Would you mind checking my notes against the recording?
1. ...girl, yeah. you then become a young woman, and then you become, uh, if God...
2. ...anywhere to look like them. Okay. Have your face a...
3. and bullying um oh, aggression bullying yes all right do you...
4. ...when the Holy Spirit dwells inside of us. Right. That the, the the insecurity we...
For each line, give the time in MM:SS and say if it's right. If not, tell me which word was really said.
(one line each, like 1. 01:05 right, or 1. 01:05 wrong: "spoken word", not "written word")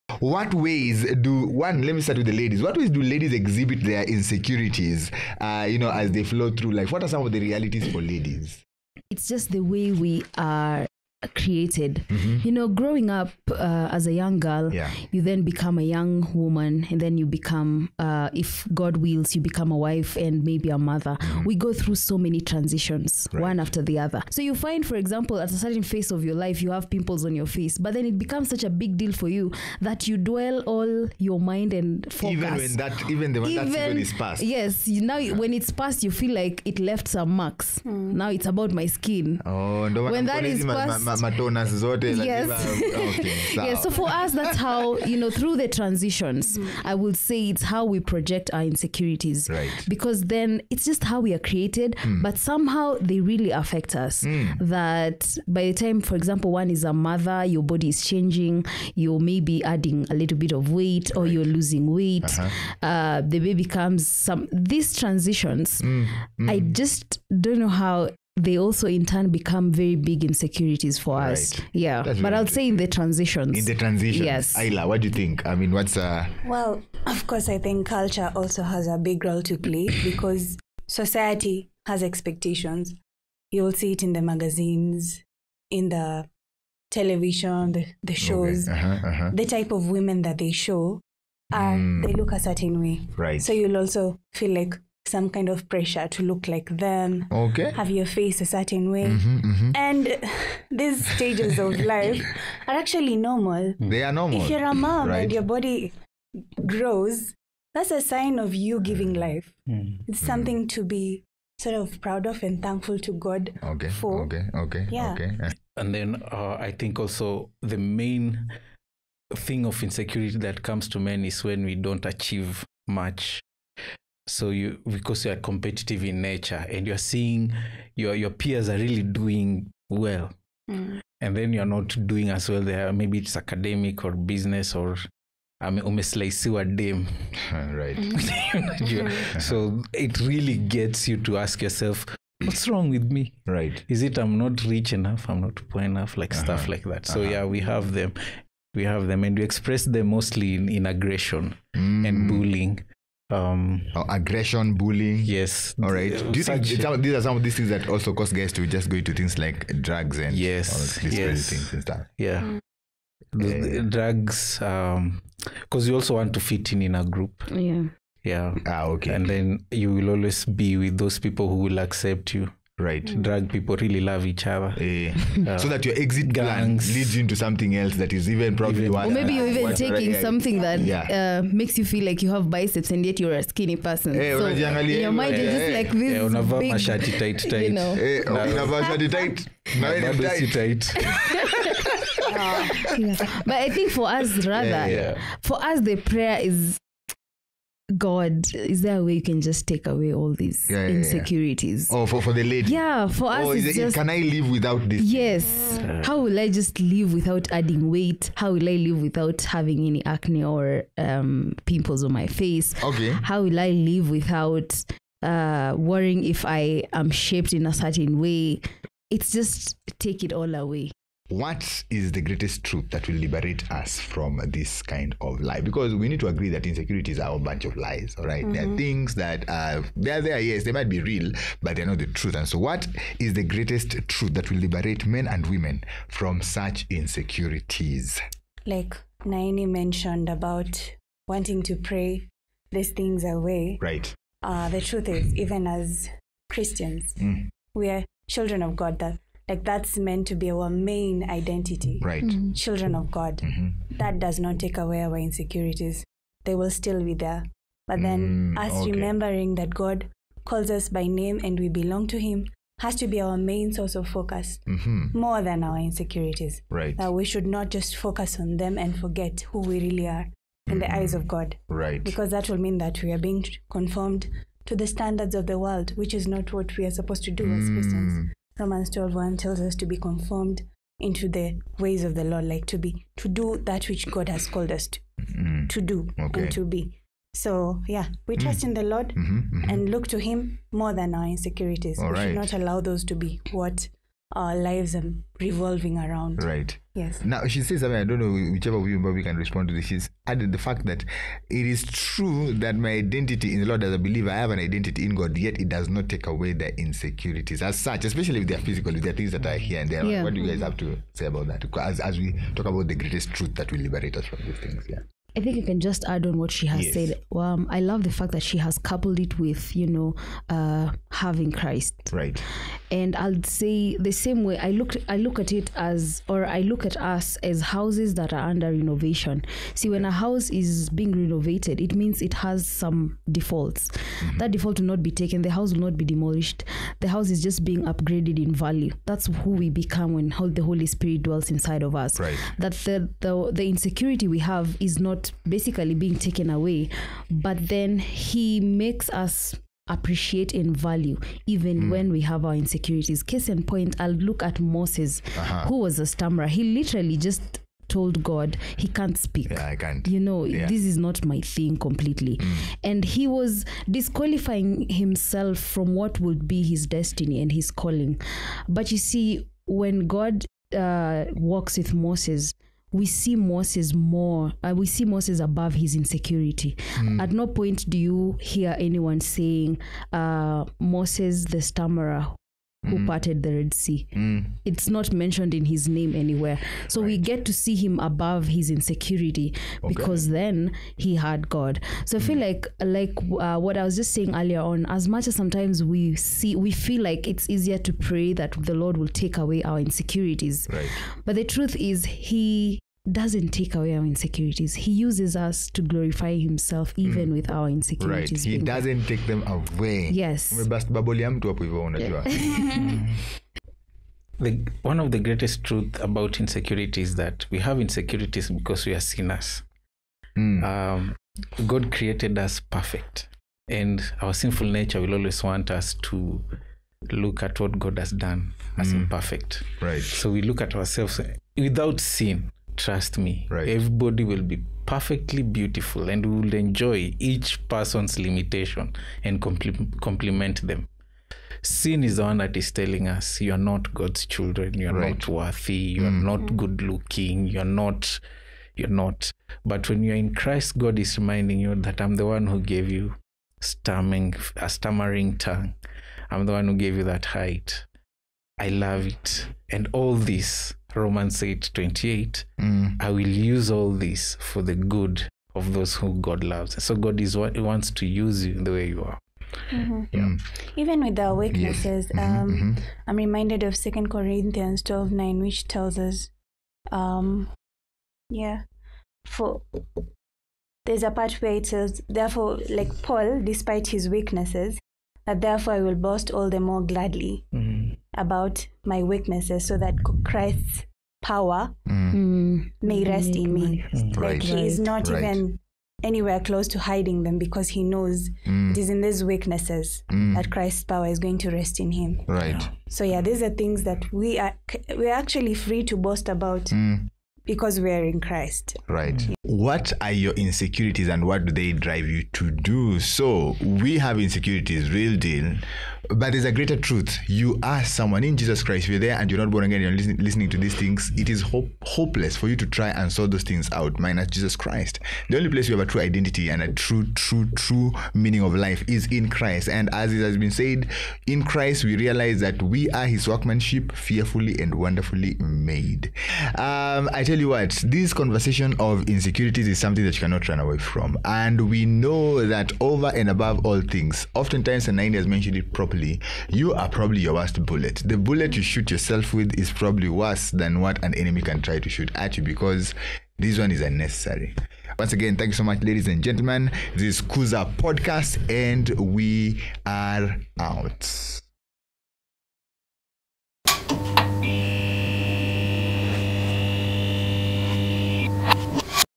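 1. 00:14 right
2. 01:35 wrong: "pressure", not "anywhere"
3. 02:32 right
4. 05:40 right.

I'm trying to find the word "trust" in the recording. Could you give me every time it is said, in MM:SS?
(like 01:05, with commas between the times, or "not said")
04:48, 07:12.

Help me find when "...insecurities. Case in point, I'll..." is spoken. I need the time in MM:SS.
05:52.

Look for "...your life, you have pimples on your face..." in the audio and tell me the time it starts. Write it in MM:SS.
00:26.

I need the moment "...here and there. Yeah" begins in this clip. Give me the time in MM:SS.
05:09.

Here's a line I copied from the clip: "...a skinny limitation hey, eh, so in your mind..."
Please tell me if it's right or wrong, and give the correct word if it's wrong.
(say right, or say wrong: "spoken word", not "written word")
wrong: "person", not "limitation".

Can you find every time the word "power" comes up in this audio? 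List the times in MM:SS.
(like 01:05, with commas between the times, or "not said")
08:11, 08:20.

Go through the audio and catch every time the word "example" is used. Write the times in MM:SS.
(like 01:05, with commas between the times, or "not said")
00:24, 00:56.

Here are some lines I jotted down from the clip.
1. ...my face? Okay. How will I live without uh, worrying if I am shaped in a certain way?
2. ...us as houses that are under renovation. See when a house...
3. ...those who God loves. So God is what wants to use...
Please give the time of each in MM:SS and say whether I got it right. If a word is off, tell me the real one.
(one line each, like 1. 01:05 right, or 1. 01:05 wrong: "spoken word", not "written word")
1. 03:32 right
2. 05:26 right
3. 07:45 right.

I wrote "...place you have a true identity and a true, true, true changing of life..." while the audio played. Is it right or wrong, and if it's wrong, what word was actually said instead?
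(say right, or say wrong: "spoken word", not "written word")
wrong: "meaning", not "changing".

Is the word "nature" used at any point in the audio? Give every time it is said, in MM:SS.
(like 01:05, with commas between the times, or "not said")
02:06, 07:04.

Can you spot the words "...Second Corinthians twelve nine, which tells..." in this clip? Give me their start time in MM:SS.
07:53.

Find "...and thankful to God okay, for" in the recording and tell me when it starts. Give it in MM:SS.
01:52.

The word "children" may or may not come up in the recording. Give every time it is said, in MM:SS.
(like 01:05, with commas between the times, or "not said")
04:08, 04:12, 07:24.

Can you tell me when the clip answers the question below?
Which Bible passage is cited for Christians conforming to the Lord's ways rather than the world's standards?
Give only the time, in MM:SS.
04:38.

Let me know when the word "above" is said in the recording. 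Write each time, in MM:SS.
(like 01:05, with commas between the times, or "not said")
06:15, 06:27, 09:03.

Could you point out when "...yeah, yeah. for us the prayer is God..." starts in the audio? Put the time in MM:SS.
03:14.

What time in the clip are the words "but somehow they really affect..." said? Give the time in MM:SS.
00:52.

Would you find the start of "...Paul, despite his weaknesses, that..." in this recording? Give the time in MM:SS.
08:03.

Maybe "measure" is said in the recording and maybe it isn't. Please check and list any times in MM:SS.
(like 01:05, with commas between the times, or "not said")
not said.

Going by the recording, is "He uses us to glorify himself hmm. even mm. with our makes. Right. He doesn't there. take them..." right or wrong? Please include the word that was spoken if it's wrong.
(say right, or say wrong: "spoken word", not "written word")
wrong: "insecurities", not "makes".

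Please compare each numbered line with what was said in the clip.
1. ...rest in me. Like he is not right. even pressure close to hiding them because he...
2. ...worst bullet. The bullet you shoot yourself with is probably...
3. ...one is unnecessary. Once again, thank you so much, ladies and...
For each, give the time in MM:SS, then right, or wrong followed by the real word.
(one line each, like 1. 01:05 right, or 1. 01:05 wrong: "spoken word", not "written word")
1. 08:13 wrong: "anywhere", not "pressure"
2. 09:07 right
3. 09:13 right.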